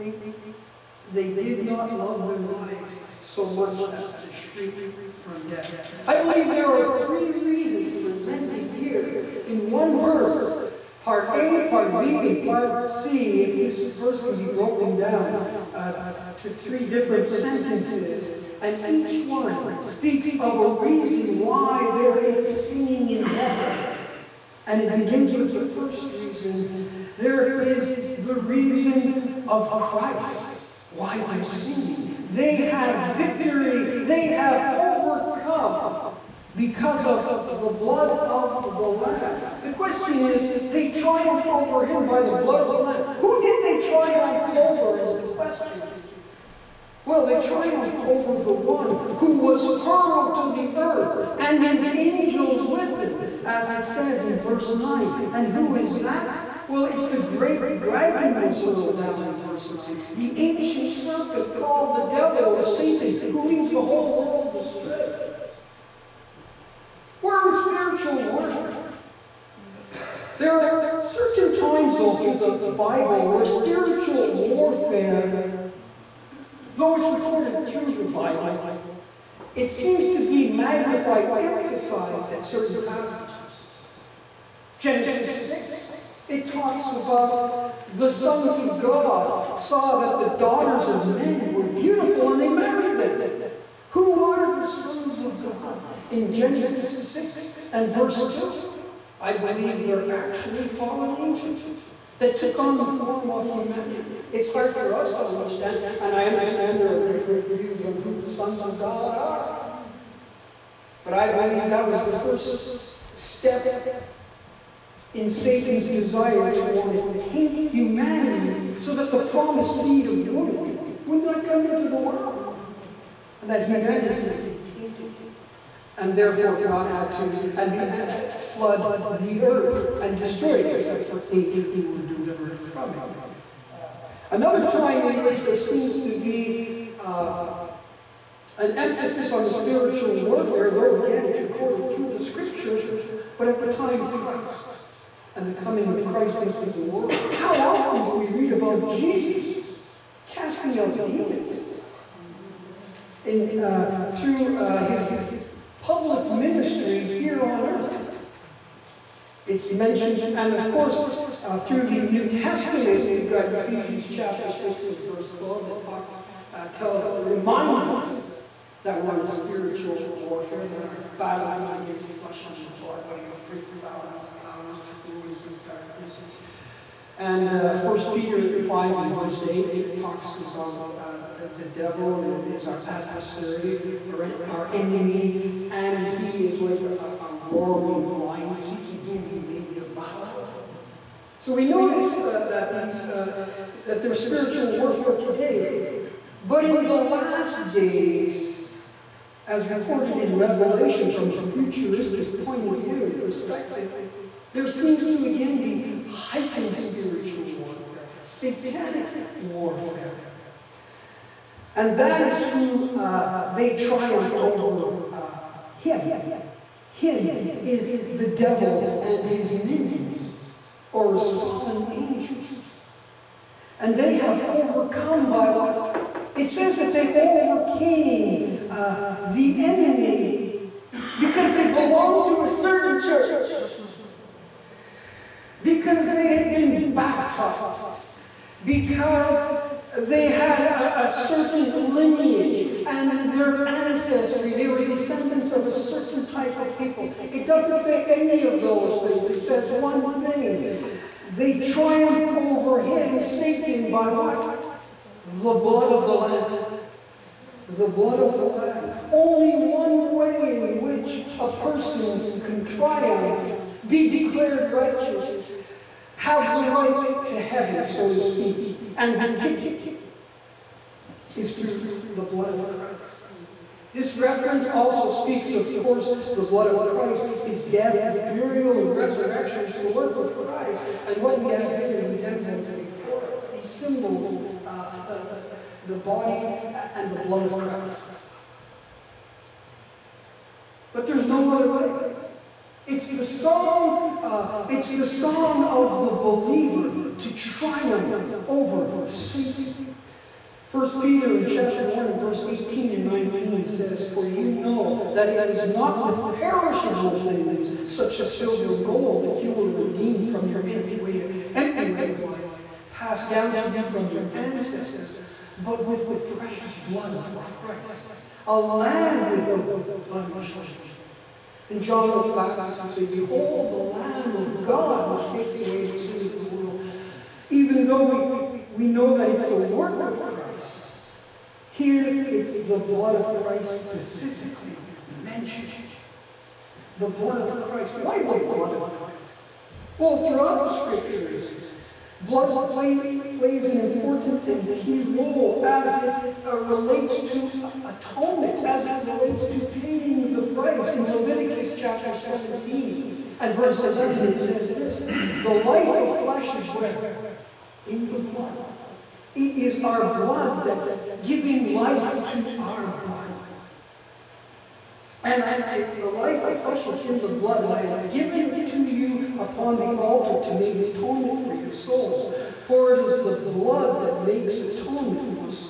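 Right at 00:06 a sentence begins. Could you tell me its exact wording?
I believe there are three reasons presented here in one verse part A, part B, and part C.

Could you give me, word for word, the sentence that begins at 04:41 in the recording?
And what we have here in these emblems before us, these symbols, uh, uh, the body and the blood of Christ.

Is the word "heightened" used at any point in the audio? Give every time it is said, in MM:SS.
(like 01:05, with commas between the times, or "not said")
03:26.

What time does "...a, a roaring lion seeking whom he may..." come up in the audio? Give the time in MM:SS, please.
03:06.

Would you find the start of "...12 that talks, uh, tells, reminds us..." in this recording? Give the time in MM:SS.
02:45.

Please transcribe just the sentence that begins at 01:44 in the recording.
It's hard for us to understand, and I understand there are different views on who the sons of God are.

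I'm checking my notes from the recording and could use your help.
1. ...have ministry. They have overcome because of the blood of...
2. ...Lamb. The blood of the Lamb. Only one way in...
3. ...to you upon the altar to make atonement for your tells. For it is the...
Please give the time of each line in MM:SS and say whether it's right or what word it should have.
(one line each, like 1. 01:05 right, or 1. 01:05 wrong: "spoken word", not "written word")
1. 00:32 wrong: "victory", not "ministry"
2. 04:16 right
3. 06:08 wrong: "souls", not "tells".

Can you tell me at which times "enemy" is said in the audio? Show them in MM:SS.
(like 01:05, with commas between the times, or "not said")
03:04, 03:49.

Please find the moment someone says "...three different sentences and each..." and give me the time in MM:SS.
00:16.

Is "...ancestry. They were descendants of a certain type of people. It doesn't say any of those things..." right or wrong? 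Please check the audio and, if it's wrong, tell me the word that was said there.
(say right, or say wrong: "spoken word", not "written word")
right.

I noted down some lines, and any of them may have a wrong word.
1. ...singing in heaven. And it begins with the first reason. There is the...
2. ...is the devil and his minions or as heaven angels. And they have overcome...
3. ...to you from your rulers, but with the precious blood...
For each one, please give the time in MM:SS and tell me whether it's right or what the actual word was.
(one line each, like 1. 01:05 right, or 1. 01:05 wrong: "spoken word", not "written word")
1. 00:22 right
2. 03:37 wrong: "fallen", not "heaven"
3. 05:13 wrong: "ancestors", not "rulers".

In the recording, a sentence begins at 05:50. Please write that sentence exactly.
In Leviticus chapter 17 and verse 11, it says this The life of flesh is where?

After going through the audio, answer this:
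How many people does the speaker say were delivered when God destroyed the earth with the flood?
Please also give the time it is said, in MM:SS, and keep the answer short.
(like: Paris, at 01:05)
8, at 02:11.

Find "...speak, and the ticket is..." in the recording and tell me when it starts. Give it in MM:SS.
04:28.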